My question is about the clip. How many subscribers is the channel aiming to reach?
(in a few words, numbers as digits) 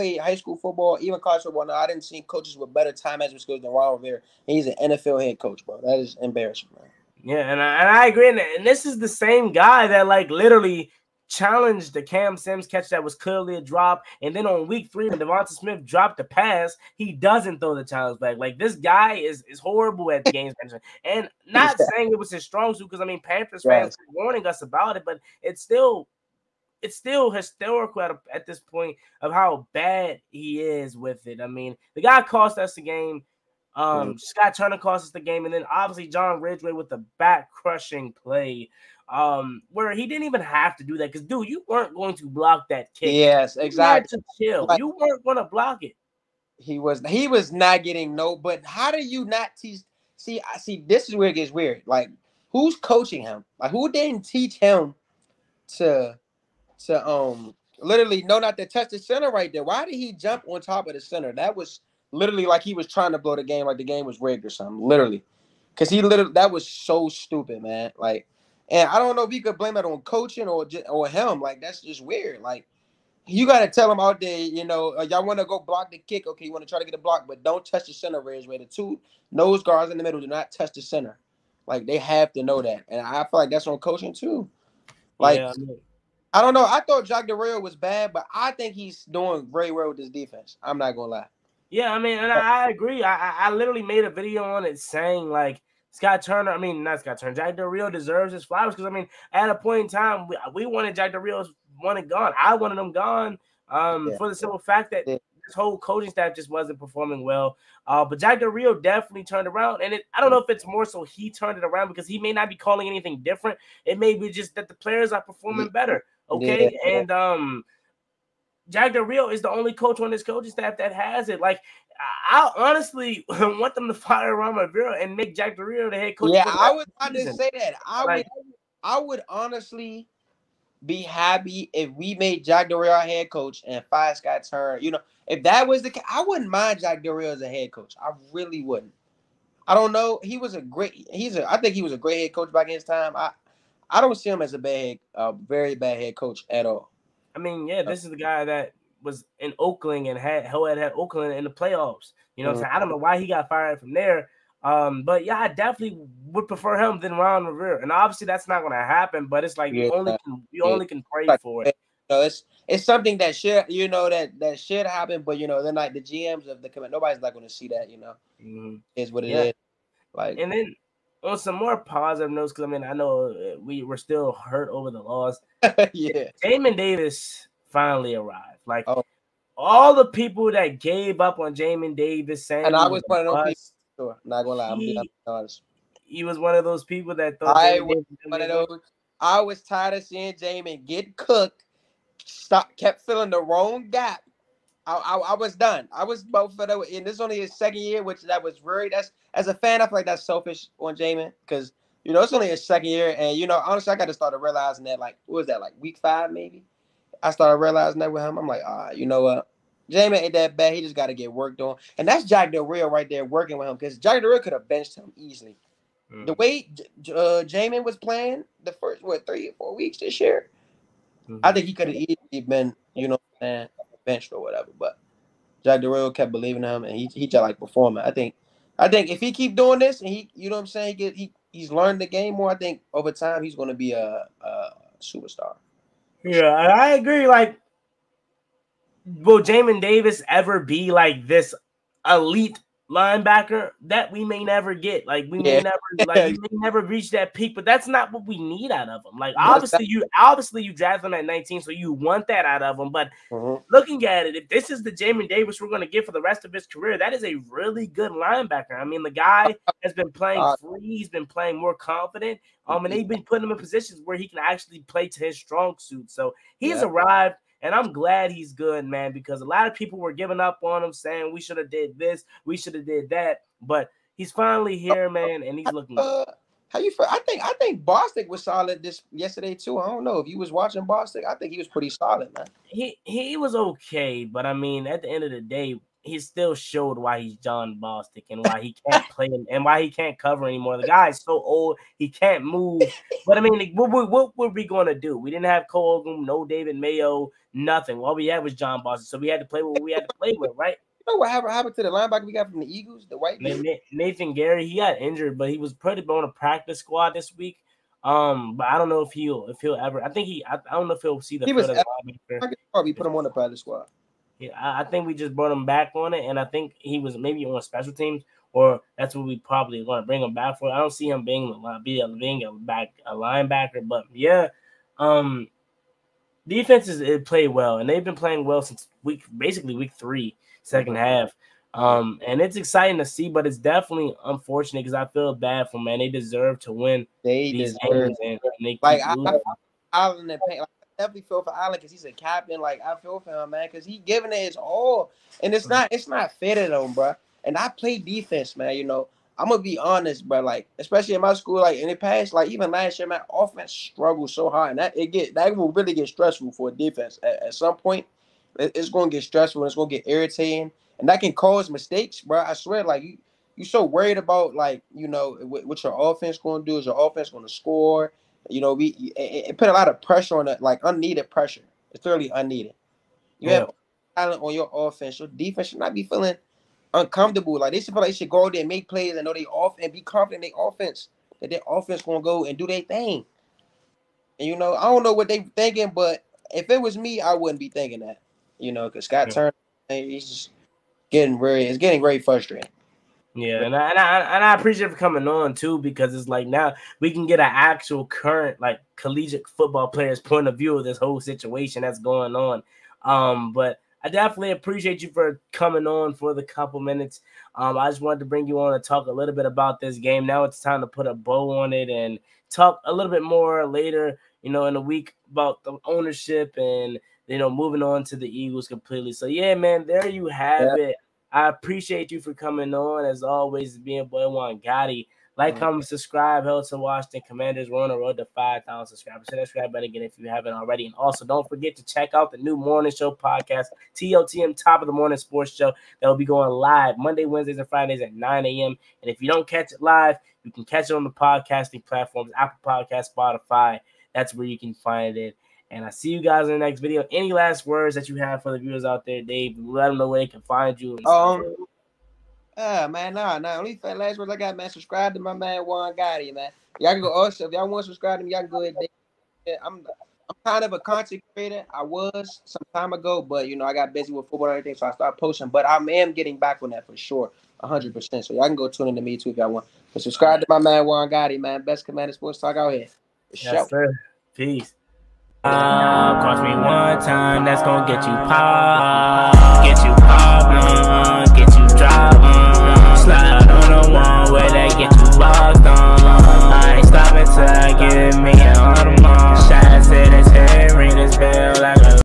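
5,000.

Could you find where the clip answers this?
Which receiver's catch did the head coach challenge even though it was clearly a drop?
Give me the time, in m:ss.
0:12.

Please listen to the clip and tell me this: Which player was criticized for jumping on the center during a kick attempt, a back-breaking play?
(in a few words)
John Ridgeway.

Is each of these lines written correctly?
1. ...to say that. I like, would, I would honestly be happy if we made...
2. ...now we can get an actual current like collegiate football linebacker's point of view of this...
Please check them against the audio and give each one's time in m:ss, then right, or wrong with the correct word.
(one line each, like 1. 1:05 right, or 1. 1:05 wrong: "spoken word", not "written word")
1. 2:07 right
2. 6:36 wrong: "player", not "linebacker".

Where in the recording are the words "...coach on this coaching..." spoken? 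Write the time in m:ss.
1:59.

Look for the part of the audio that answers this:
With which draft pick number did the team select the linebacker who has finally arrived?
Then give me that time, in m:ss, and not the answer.
4:11.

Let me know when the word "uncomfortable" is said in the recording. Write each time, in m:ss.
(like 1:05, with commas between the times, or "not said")
6:16.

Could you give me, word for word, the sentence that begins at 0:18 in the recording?
Like this guy is is horrible at the games management.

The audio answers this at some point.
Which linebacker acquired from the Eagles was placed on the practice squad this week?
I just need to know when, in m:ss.
5:03.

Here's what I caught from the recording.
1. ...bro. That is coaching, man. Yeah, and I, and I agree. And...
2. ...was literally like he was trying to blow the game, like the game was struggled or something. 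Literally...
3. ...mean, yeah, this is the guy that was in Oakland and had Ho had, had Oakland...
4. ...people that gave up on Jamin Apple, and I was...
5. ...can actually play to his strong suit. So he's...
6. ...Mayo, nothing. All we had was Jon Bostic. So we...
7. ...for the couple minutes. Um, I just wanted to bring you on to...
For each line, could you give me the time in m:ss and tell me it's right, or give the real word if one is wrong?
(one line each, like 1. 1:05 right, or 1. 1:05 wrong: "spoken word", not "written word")
1. 0:05 wrong: "embarrassing", not "coaching"
2. 1:01 wrong: "rigged", not "struggled"
3. 2:27 right
4. 3:00 wrong: "Davis", not "Apple"
5. 4:24 right
6. 4:56 right
7. 6:46 right.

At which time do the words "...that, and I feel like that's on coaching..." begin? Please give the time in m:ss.
1:22.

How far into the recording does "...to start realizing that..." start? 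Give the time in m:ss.
3:24.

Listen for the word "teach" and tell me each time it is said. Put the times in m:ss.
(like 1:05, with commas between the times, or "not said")
0:49, 0:54.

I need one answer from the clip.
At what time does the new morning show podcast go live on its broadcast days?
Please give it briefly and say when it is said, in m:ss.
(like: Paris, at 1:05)
9 a.m., at 7:18.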